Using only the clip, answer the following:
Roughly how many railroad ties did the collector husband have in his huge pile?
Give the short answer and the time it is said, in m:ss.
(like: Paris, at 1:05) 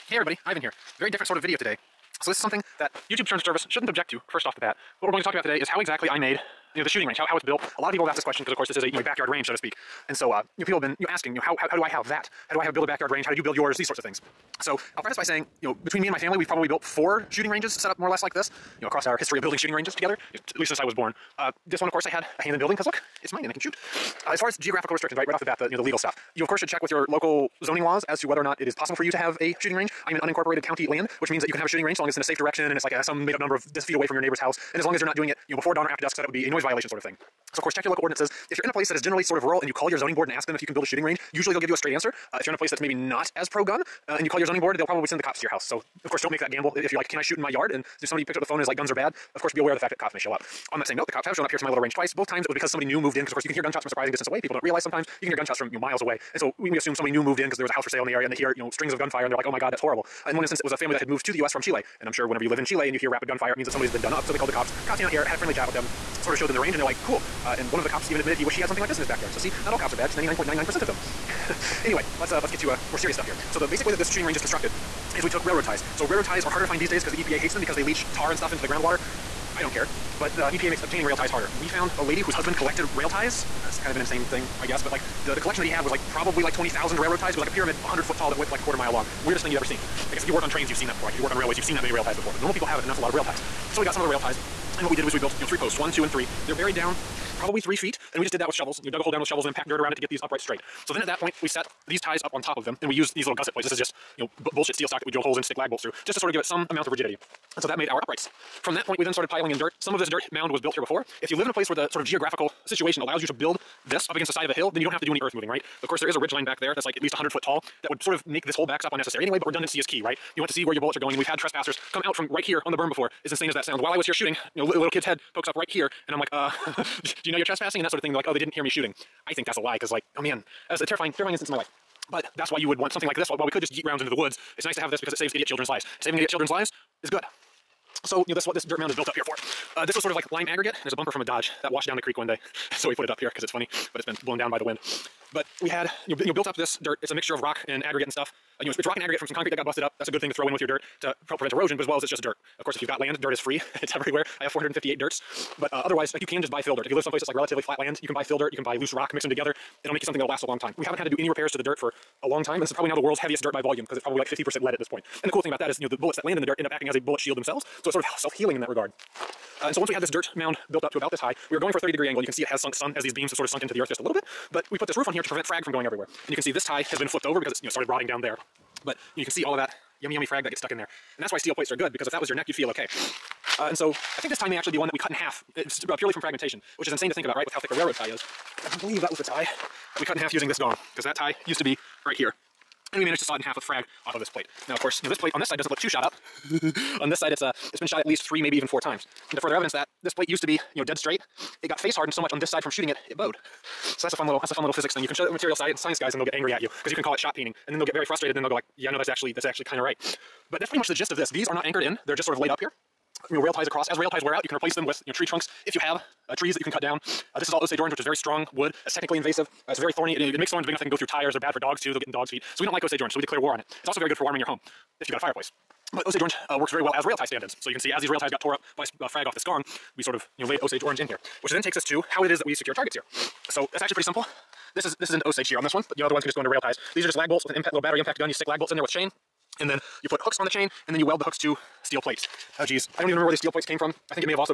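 20,000, at 1:26.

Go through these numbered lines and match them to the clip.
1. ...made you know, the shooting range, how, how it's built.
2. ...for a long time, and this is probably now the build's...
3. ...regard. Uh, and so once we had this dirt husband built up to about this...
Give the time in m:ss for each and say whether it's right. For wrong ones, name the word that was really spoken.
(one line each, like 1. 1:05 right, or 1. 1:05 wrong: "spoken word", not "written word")
1. 0:06 right
2. 2:41 wrong: "world", not "build"
3. 2:48 wrong: "mound", not "husband".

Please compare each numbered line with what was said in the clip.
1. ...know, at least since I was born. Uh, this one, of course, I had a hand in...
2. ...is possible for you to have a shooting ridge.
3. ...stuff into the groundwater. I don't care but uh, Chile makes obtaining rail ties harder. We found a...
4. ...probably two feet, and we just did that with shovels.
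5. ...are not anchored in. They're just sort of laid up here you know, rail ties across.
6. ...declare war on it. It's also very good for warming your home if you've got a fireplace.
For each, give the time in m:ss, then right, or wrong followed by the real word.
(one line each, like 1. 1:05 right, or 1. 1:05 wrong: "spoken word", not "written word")
1. 0:20 right
2. 0:28 wrong: "range", not "ridge"
3. 1:18 wrong: "EPA", not "Chile"
4. 1:37 wrong: "three", not "two"
5. 3:31 right
6. 3:43 right.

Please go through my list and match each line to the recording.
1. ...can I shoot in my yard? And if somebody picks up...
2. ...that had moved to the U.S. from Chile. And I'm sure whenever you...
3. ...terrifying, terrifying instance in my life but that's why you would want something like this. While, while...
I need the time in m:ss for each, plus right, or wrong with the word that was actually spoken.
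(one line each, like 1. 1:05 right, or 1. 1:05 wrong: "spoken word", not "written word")
1. 0:47 right
2. 1:00 right
3. 2:10 right.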